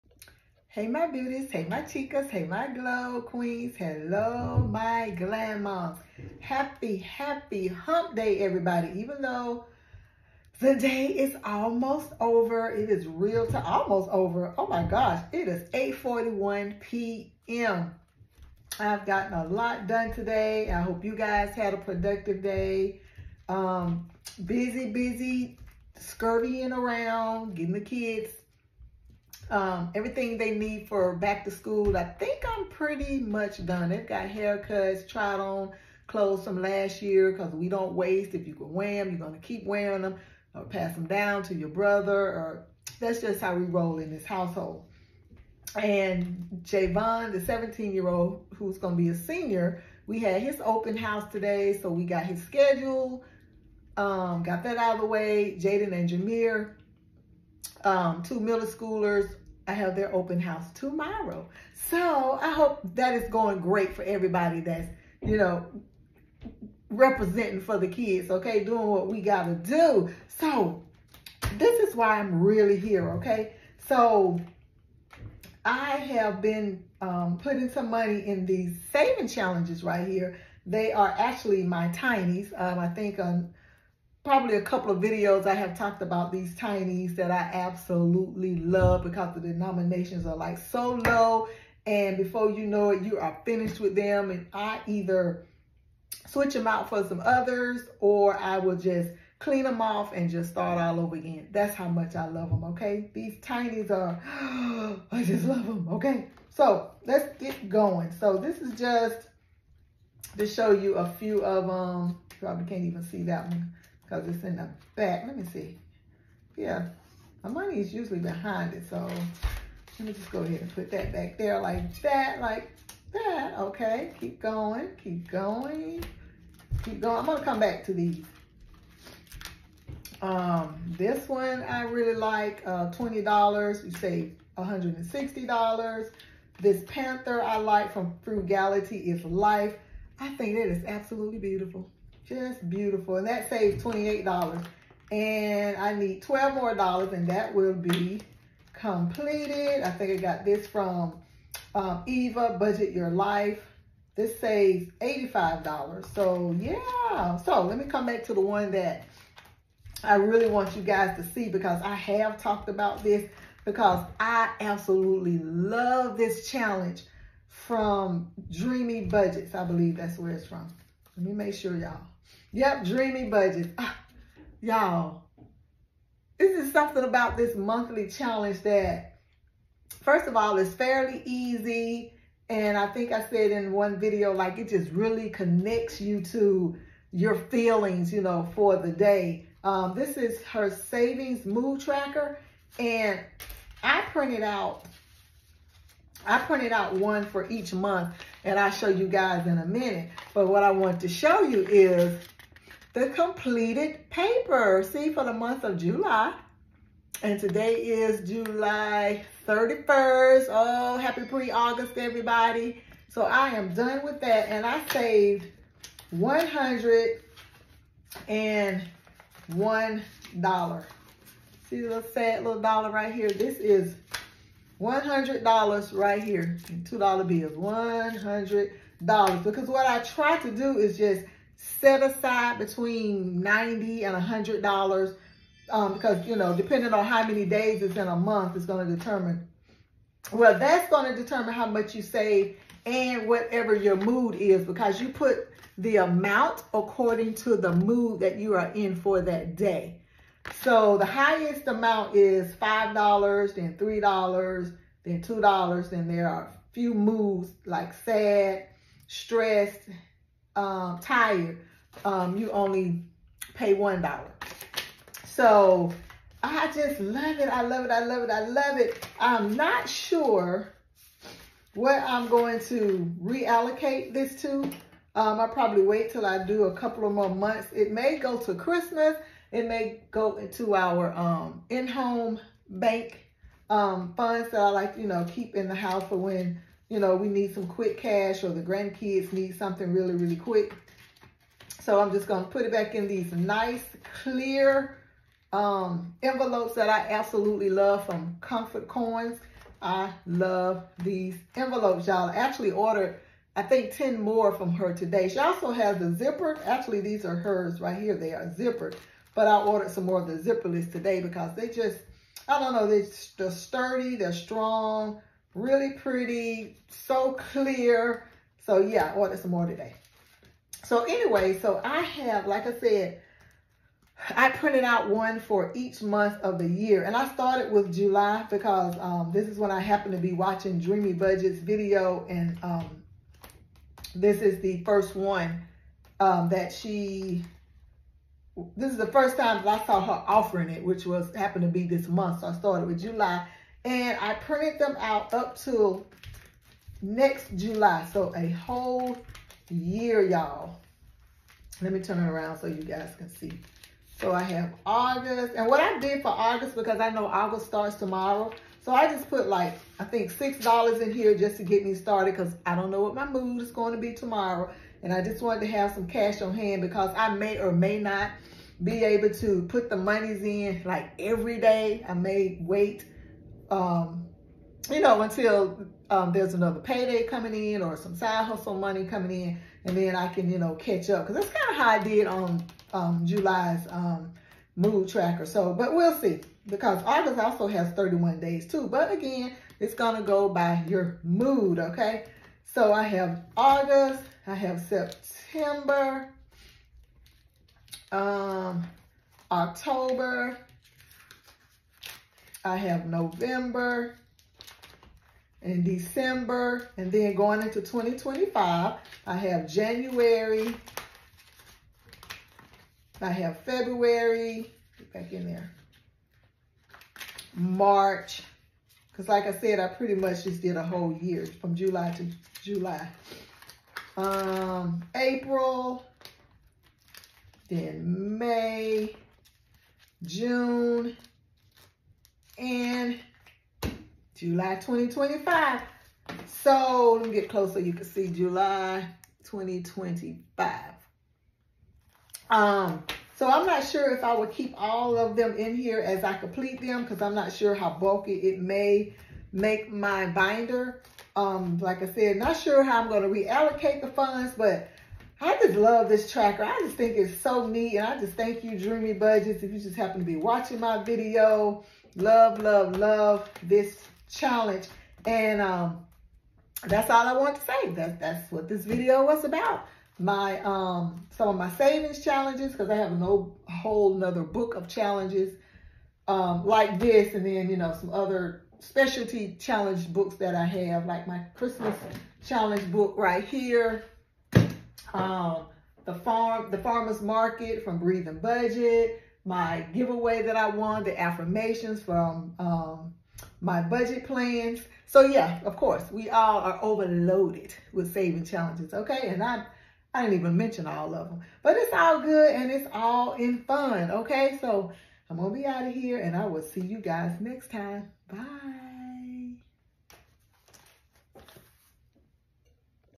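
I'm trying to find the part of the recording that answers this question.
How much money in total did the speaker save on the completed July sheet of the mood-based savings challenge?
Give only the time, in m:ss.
3:36.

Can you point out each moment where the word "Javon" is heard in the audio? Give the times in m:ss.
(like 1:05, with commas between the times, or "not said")
0:46.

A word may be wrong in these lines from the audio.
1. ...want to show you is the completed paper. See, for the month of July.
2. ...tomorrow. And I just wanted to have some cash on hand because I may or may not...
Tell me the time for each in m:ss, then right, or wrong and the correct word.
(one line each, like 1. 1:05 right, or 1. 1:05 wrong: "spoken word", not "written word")
1. 3:20 right
2. 6:04 right.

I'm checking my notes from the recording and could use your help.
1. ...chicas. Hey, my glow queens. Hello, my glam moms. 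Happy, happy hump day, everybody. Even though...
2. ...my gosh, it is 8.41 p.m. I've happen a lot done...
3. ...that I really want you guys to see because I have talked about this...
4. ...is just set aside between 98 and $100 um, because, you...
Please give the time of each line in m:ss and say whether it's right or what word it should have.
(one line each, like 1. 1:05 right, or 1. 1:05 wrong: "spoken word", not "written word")
1. 0:01 right
2. 0:14 wrong: "gotten", not "happen"
3. 2:38 right
4. 3:50 wrong: "90", not "98".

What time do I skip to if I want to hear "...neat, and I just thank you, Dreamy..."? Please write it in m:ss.
7:37.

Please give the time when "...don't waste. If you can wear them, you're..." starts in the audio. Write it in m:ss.
0:37.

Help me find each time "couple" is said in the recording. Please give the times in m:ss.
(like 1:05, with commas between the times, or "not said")
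1:24, 4:36.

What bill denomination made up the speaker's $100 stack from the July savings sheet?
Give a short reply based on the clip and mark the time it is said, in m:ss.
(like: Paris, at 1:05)
$2 bills, at 3:46.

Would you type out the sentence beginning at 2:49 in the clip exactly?
I believe that's where it's from.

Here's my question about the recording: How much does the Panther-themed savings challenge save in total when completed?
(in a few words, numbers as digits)
$28.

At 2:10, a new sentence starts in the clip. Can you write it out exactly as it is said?
Um, this one I really like, uh, $20, you save $160.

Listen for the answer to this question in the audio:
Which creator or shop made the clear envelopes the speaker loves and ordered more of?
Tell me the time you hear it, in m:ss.
4:58.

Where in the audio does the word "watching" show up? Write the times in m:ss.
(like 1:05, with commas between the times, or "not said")
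5:30, 7:40.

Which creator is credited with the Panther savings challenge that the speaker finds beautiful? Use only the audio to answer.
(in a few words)
Frugality is Life.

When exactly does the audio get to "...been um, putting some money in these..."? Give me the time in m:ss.
1:16.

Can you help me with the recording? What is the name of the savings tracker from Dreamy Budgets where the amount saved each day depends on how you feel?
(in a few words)
savings mood tracker.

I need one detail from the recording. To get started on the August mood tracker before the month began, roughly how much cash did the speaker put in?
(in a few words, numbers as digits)
$6.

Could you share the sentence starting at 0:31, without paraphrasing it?
I think I'm pretty much done.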